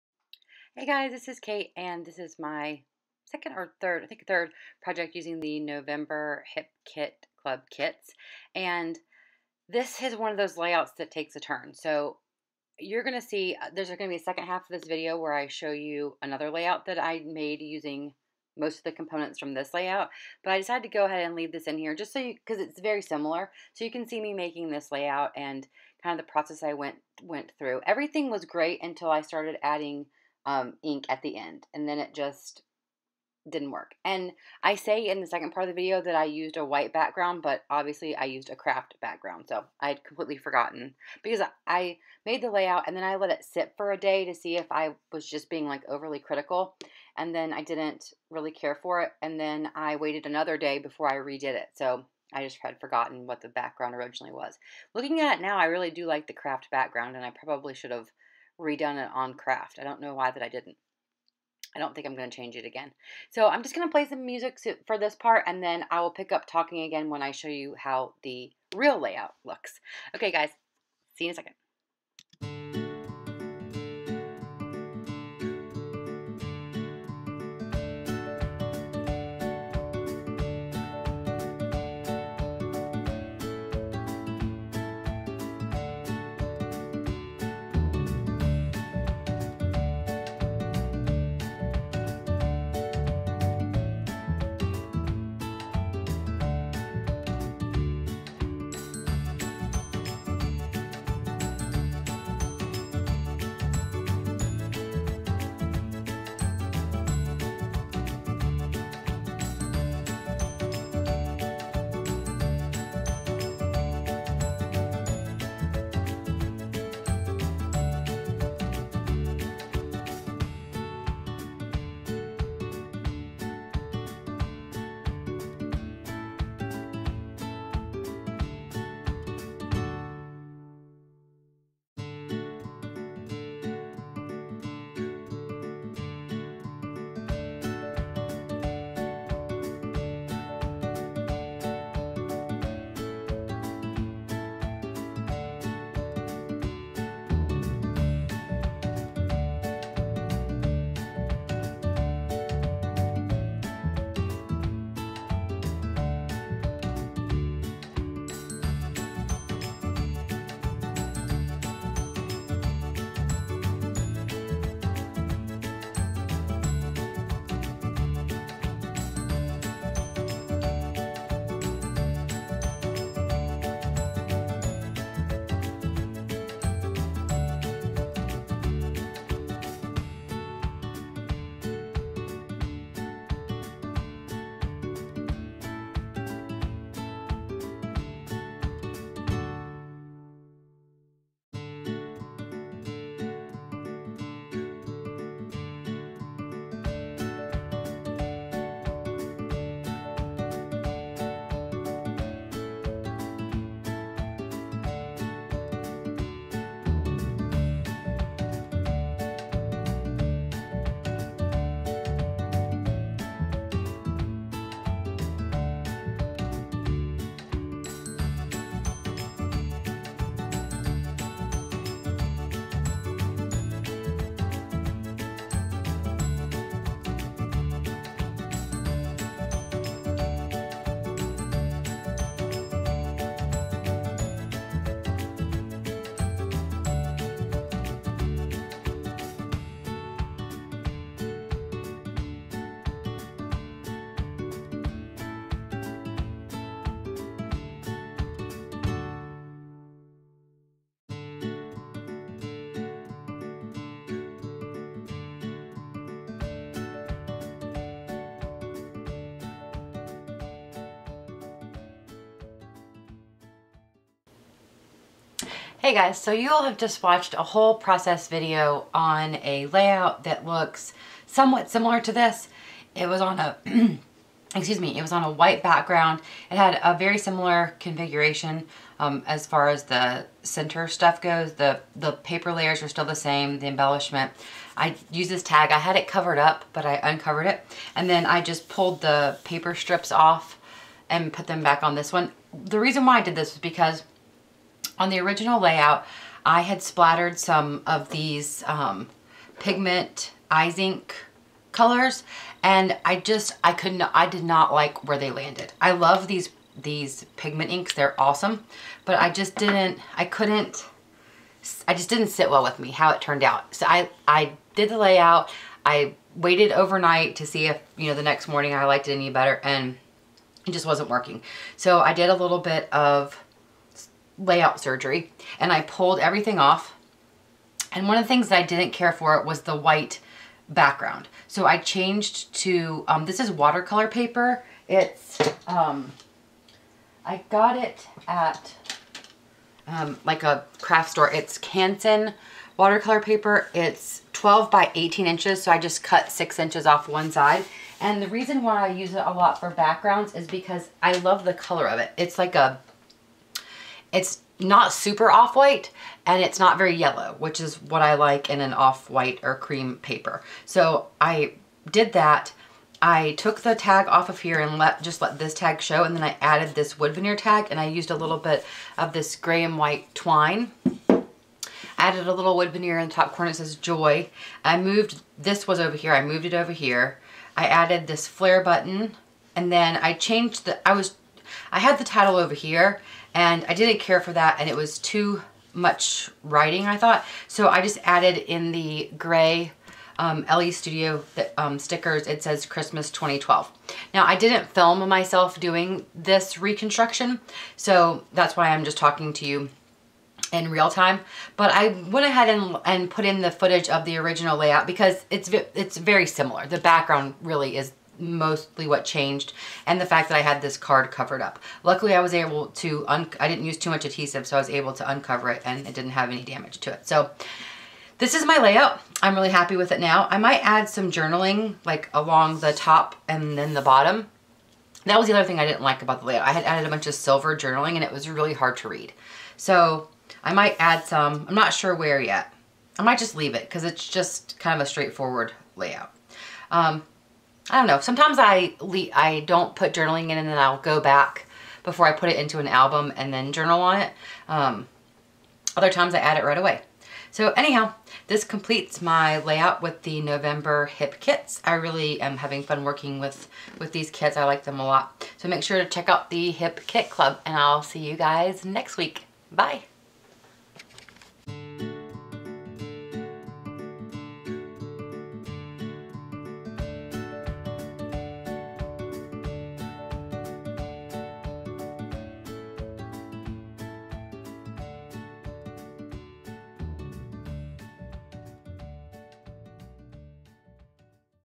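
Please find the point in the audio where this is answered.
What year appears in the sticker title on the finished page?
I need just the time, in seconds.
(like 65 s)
393 s.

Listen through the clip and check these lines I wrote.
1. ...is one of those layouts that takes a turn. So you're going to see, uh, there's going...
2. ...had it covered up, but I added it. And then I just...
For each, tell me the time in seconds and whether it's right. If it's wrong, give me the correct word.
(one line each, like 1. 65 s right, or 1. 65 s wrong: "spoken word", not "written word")
1. 10 s right
2. 285 s wrong: "uncovered", not "added".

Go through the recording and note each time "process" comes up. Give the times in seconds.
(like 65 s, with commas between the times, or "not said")
26 s, 267 s.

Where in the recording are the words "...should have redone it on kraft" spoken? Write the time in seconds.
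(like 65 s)
57 s.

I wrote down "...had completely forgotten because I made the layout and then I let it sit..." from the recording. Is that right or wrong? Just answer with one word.
right.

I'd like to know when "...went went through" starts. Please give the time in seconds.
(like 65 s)
26 s.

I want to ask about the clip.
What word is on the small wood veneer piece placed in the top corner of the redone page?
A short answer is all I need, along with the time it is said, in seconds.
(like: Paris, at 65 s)
Joy, at 373 s.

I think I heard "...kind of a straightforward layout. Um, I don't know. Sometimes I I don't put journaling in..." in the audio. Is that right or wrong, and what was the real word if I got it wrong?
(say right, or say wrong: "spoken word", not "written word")
right.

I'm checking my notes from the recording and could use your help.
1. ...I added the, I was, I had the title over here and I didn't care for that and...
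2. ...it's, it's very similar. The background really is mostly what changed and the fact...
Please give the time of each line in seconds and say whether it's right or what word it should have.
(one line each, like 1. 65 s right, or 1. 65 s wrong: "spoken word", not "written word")
1. 379 s wrong: "changed", not "added"
2. 405 s right.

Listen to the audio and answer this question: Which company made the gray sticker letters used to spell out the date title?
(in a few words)
Elle's Studio.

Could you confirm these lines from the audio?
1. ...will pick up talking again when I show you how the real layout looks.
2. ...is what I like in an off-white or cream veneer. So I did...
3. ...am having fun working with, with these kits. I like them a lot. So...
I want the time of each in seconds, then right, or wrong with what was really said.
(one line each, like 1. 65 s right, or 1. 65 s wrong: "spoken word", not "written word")
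1. 66 s right
2. 357 s wrong: "paper", not "veneer"
3. 452 s right.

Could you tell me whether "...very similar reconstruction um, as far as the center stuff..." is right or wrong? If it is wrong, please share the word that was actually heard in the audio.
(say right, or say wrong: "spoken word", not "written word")
wrong: "configuration", not "reconstruction".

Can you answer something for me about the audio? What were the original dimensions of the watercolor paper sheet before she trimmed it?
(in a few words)
12 by 18 inches.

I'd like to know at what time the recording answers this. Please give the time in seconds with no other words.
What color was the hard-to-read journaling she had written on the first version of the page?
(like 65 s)
427 s.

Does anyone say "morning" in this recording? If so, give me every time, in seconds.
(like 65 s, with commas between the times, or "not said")
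318 s.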